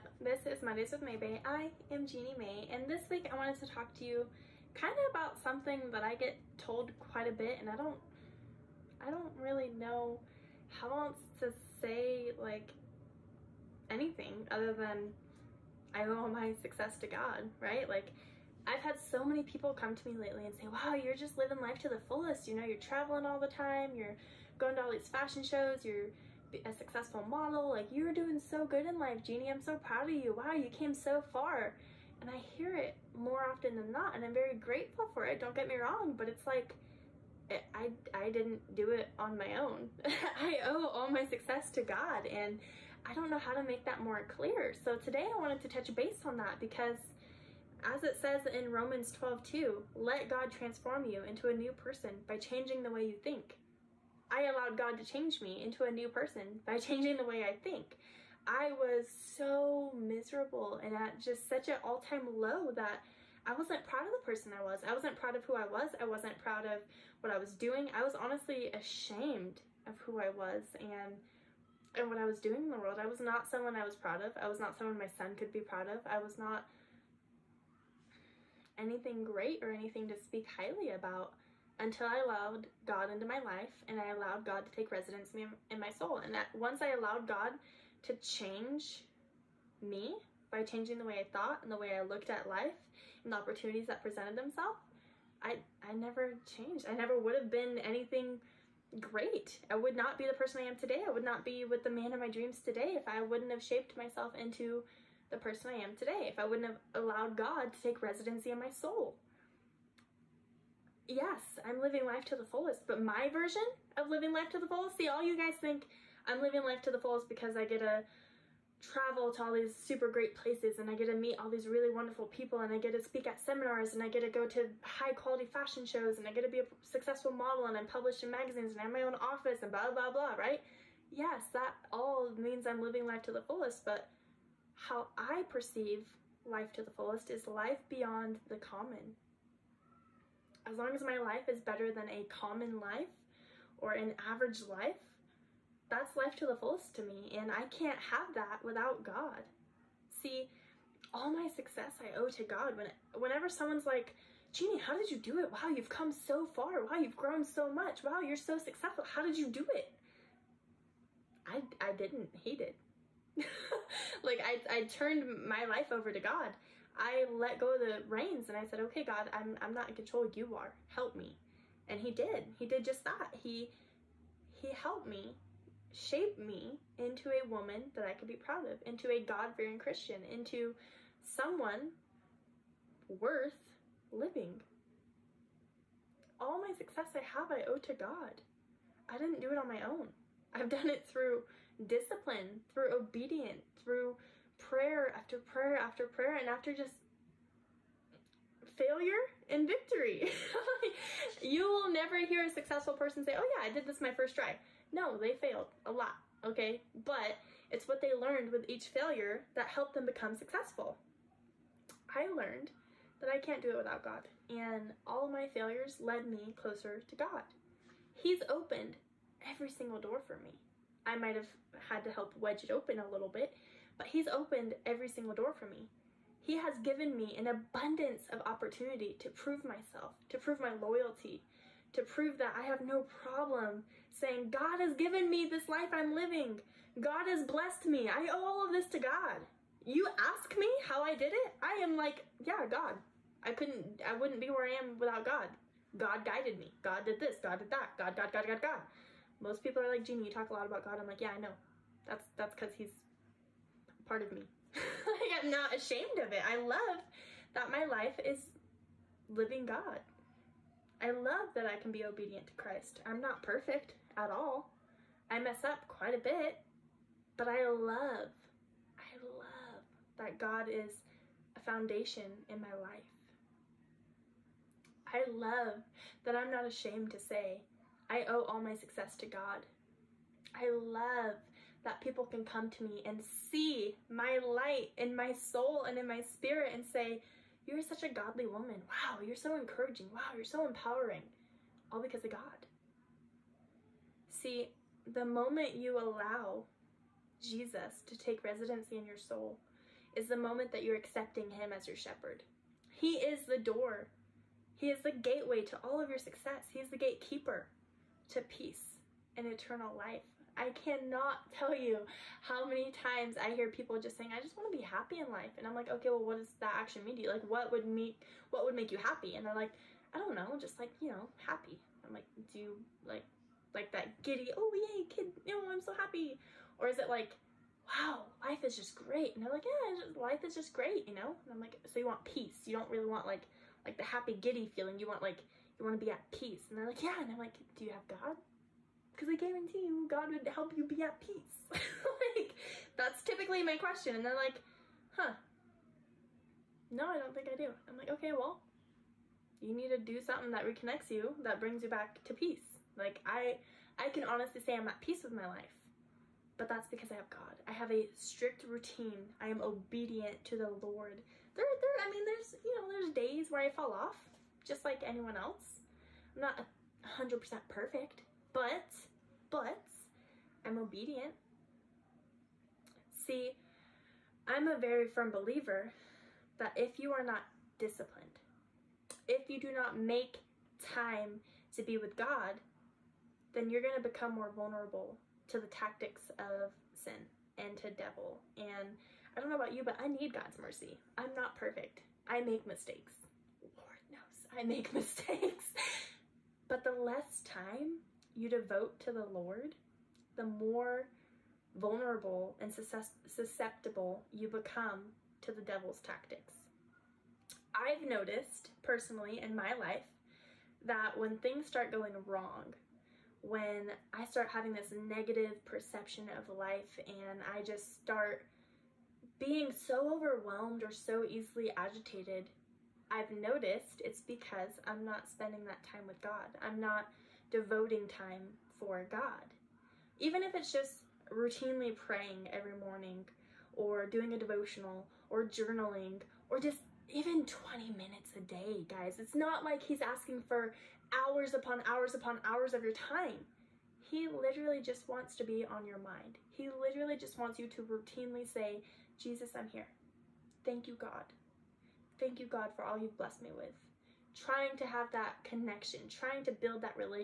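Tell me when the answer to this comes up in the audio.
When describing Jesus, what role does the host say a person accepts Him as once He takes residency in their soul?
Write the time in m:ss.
5:01.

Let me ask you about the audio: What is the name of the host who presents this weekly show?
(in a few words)
Jeannie Mae.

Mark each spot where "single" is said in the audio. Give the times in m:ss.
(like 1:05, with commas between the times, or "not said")
3:39, 3:45.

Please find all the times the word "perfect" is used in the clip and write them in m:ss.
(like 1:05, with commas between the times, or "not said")
4:23, 6:07, 6:31.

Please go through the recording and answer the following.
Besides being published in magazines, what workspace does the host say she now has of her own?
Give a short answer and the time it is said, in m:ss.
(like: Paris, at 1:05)
office, at 2:09.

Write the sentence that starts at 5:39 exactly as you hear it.
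because I guarantee you God would help you be at peace.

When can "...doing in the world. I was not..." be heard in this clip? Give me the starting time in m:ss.
1:12.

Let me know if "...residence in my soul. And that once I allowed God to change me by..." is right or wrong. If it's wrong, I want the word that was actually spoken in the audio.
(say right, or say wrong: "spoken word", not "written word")
right.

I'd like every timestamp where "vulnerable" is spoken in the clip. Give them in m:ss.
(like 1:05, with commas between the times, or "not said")
6:24, 6:41.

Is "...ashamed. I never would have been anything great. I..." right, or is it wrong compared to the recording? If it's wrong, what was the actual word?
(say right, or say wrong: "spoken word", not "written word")
wrong: "changed", not "ashamed".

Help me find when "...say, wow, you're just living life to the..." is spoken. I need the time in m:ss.
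0:20.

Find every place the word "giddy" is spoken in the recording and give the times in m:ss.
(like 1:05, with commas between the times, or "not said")
5:24, 5:34.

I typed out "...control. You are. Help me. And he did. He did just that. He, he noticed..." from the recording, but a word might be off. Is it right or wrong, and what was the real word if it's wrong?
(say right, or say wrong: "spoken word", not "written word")
wrong: "helped", not "noticed".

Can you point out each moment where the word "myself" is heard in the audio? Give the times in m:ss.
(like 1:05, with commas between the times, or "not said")
1:43, 3:49.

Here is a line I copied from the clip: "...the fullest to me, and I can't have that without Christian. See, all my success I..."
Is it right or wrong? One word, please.
wrong.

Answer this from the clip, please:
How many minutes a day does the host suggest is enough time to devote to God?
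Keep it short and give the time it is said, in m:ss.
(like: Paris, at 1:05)
20, at 7:17.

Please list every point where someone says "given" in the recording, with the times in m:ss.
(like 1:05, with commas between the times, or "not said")
3:46, 3:54.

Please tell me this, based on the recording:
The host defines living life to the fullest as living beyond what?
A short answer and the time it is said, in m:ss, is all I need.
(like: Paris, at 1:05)
the common, at 2:18.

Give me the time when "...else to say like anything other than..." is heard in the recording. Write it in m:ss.
0:11.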